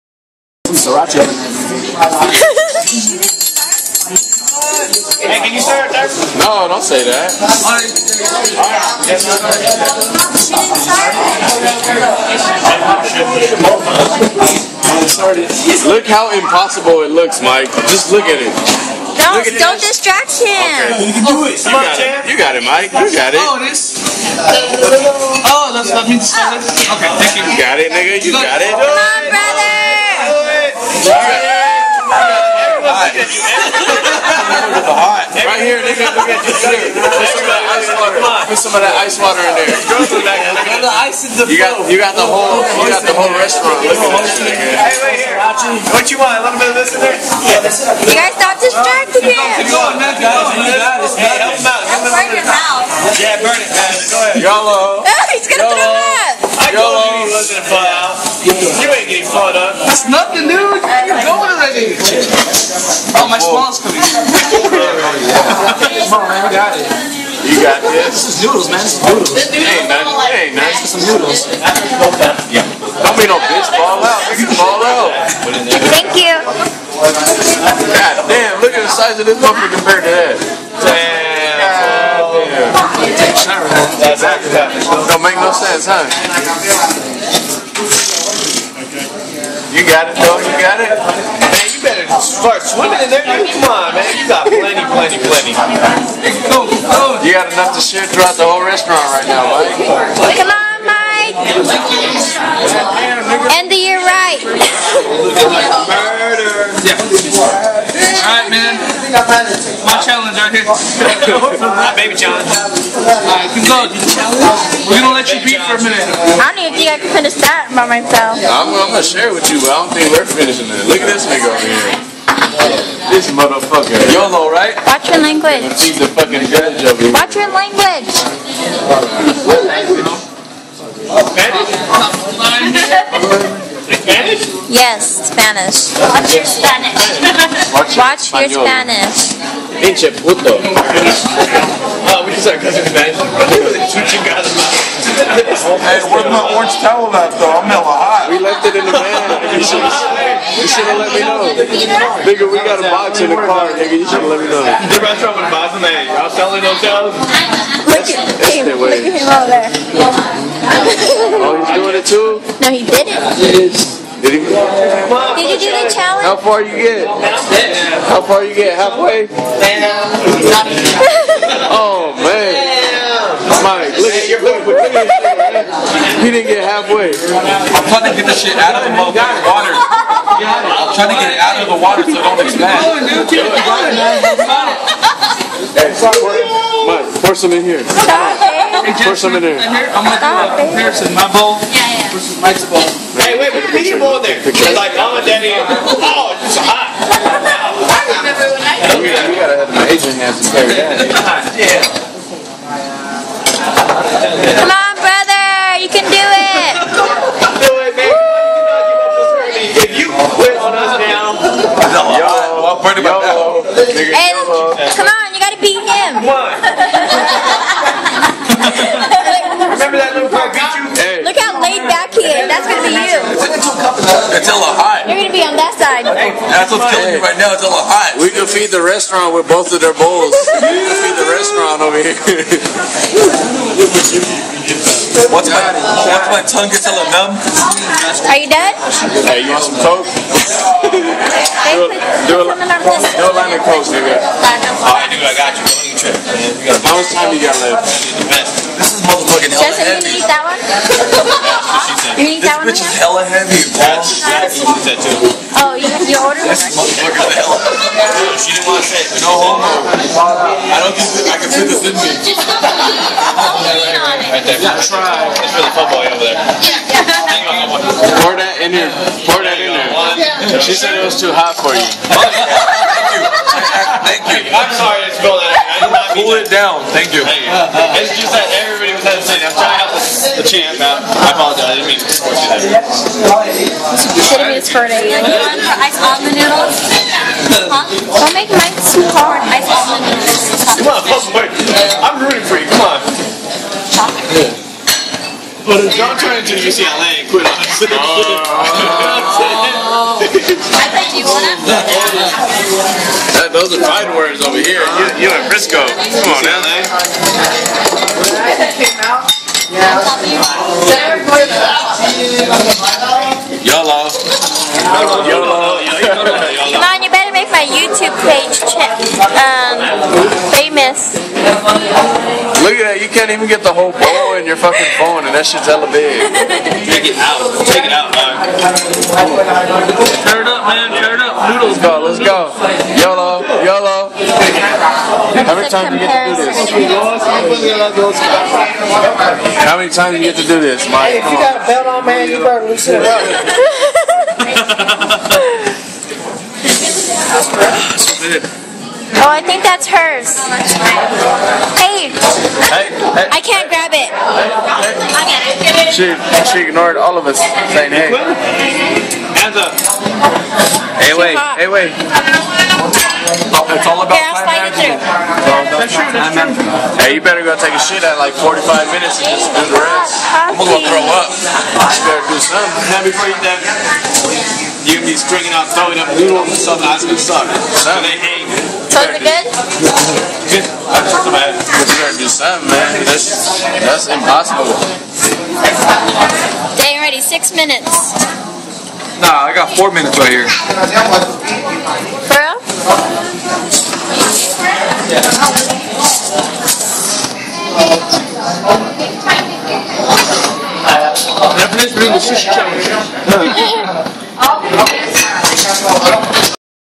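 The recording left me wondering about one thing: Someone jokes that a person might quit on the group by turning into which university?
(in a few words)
UCLA.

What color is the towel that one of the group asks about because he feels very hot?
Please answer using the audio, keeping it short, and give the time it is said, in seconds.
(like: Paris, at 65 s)
Orange, at 146 s.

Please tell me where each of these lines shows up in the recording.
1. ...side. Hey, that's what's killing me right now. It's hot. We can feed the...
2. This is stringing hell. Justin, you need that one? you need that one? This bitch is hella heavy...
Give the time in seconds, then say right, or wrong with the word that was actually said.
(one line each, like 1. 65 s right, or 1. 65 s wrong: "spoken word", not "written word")
1. 225 s right
2. 248 s wrong: "motherfucking", not "stringing".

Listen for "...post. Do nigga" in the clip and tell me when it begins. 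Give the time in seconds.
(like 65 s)
243 s.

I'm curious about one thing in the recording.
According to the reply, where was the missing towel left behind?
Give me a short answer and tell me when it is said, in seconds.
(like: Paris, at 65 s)
In the van, at 148 s.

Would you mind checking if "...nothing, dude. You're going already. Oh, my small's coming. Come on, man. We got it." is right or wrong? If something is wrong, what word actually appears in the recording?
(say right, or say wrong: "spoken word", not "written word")
right.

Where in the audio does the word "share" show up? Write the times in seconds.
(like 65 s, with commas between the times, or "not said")
97 s, 119 s.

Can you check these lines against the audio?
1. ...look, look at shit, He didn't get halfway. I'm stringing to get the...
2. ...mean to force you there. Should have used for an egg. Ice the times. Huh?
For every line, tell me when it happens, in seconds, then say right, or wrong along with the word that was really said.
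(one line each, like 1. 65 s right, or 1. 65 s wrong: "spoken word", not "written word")
1. 174 s wrong: "trying", not "stringing"
2. 281 s wrong: "noodles", not "times".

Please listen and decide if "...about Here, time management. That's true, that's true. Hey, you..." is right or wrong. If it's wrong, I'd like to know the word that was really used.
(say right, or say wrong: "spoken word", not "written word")
right.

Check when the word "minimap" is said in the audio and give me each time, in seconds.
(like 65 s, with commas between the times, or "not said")
not said.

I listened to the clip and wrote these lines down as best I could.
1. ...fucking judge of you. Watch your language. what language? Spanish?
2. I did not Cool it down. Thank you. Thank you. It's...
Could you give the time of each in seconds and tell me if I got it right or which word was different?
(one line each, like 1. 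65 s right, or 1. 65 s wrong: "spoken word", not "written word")
1. 126 s right
2. 275 s right.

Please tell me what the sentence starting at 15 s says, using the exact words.
Look how impossible it looks, Mike.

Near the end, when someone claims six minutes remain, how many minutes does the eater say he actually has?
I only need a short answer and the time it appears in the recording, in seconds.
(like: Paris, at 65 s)
4, at 389 s.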